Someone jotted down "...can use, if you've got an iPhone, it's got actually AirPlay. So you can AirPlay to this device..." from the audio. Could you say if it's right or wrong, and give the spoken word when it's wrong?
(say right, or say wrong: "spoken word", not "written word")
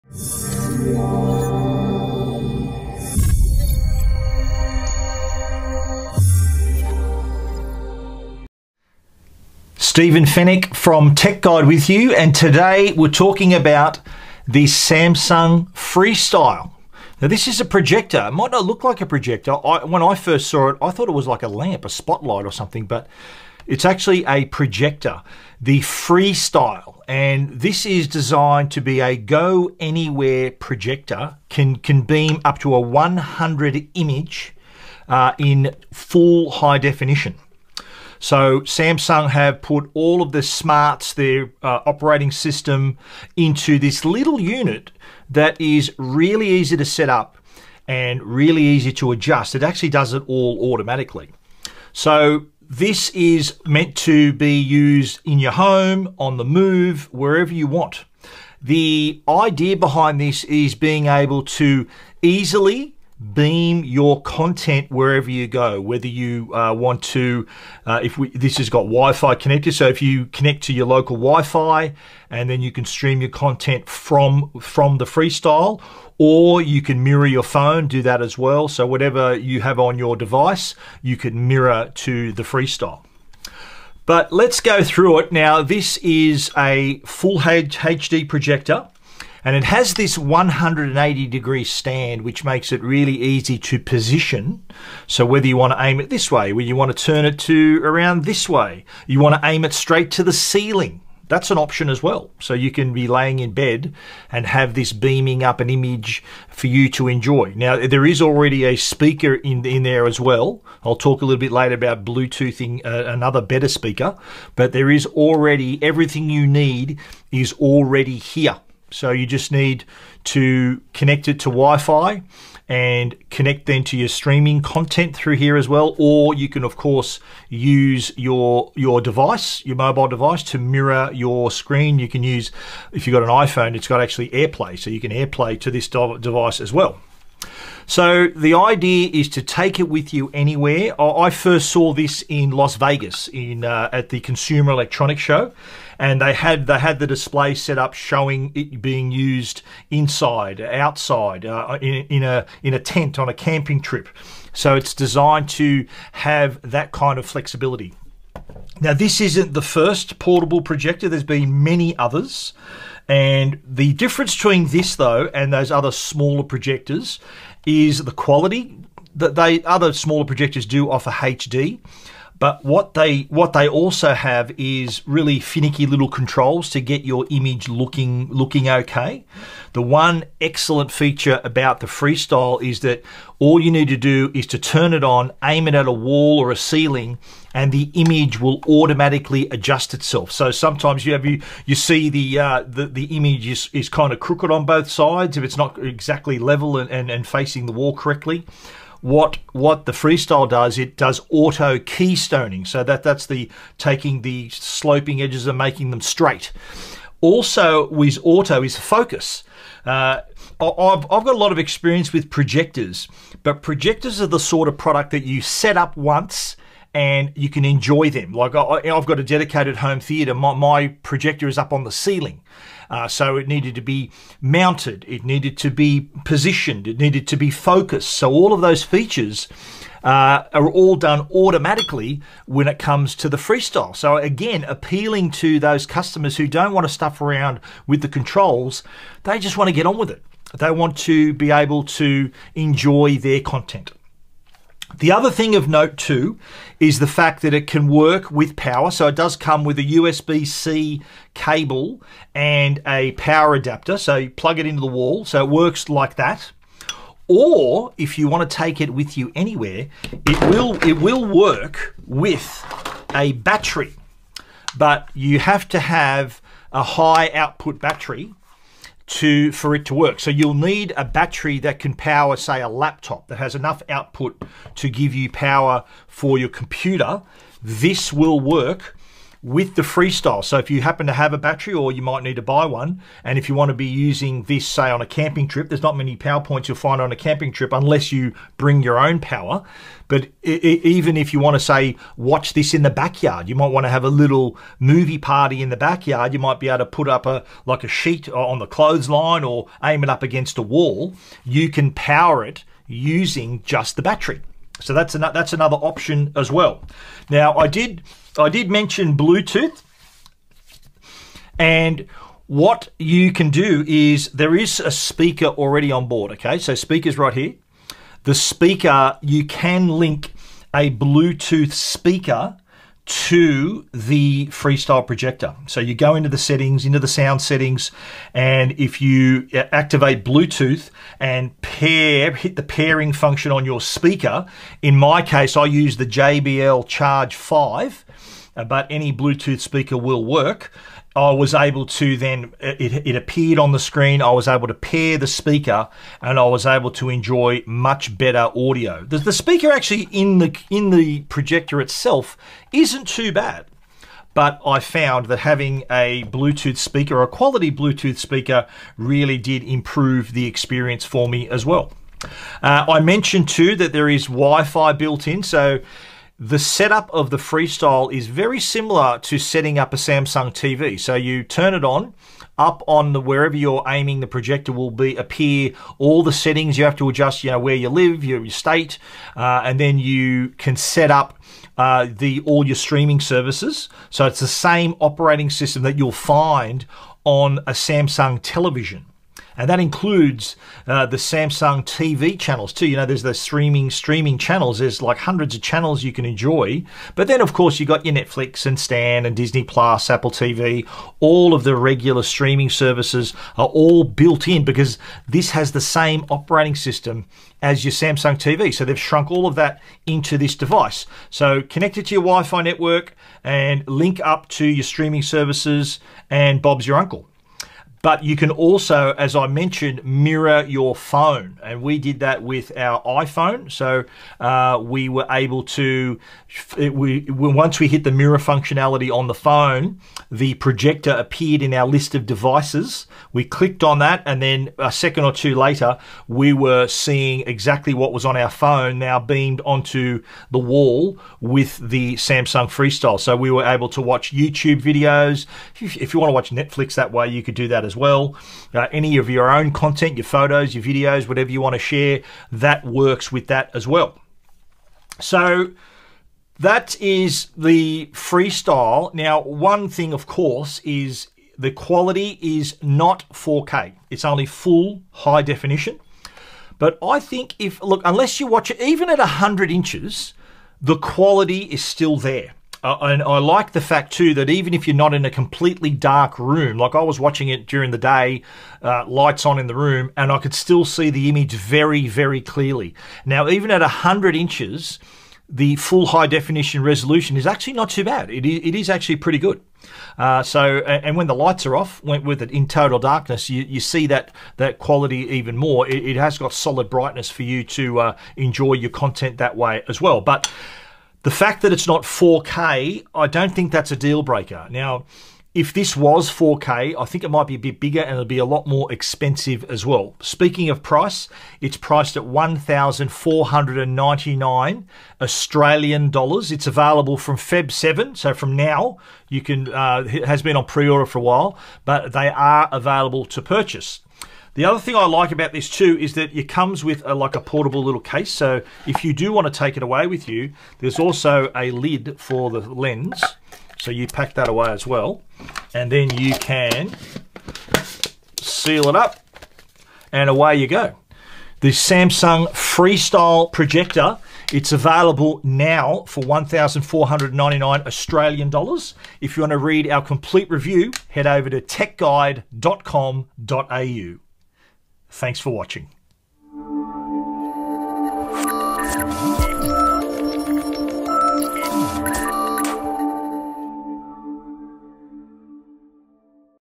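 right.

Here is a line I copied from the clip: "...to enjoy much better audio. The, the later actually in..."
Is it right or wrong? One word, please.
wrong.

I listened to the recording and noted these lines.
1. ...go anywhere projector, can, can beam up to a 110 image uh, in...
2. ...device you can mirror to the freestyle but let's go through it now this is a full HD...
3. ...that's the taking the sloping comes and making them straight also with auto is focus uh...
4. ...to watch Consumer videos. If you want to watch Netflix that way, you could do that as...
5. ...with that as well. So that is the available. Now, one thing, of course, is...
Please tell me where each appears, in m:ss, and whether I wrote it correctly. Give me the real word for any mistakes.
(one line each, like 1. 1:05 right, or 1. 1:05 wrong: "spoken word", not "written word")
1. 0:29 wrong: "100", not "110"
2. 1:20 right
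3. 3:23 wrong: "edges", not "comes"
4. 7:23 wrong: "YouTube", not "Consumer"
5. 7:33 wrong: "freestyle", not "available".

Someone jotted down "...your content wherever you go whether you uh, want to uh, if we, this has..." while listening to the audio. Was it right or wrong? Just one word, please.
right.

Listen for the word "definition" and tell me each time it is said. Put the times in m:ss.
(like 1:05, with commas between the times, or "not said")
0:36, 7:45, 8:06.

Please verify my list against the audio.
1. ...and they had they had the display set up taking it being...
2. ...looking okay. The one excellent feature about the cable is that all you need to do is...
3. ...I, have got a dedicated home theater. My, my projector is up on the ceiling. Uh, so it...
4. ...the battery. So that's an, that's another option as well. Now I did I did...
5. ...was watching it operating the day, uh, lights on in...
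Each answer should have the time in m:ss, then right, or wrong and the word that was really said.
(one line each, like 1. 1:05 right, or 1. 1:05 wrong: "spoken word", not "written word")
1. 2:25 wrong: "showing", not "taking"
2. 2:58 wrong: "freestyle", not "cable"
3. 3:38 right
4. 5:03 right
5. 7:57 wrong: "during", not "operating".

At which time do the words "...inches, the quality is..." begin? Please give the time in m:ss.
7:49.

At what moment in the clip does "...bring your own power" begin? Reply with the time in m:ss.
4:48.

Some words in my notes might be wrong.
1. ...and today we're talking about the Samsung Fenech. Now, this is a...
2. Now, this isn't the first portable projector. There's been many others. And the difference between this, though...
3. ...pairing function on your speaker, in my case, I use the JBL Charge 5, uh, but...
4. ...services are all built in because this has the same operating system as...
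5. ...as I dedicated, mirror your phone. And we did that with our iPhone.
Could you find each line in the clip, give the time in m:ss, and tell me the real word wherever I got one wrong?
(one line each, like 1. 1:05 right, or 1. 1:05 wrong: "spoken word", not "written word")
1. 0:12 wrong: "Freestyle", not "Fenech"
2. 2:38 right
3. 5:32 right
4. 6:42 right
5. 6:59 wrong: "mentioned", not "dedicated".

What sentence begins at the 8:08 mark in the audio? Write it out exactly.
It is, it is actually pretty good.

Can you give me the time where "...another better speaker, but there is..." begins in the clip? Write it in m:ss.
1:53.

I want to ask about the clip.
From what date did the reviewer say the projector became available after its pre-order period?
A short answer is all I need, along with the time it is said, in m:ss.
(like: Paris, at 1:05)
Feb 7, at 8:37.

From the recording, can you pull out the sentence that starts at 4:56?
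You might be able to put up a like a sheet uh, on the clothesline or aim it up against a wall.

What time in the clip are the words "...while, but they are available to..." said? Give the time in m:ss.
8:41.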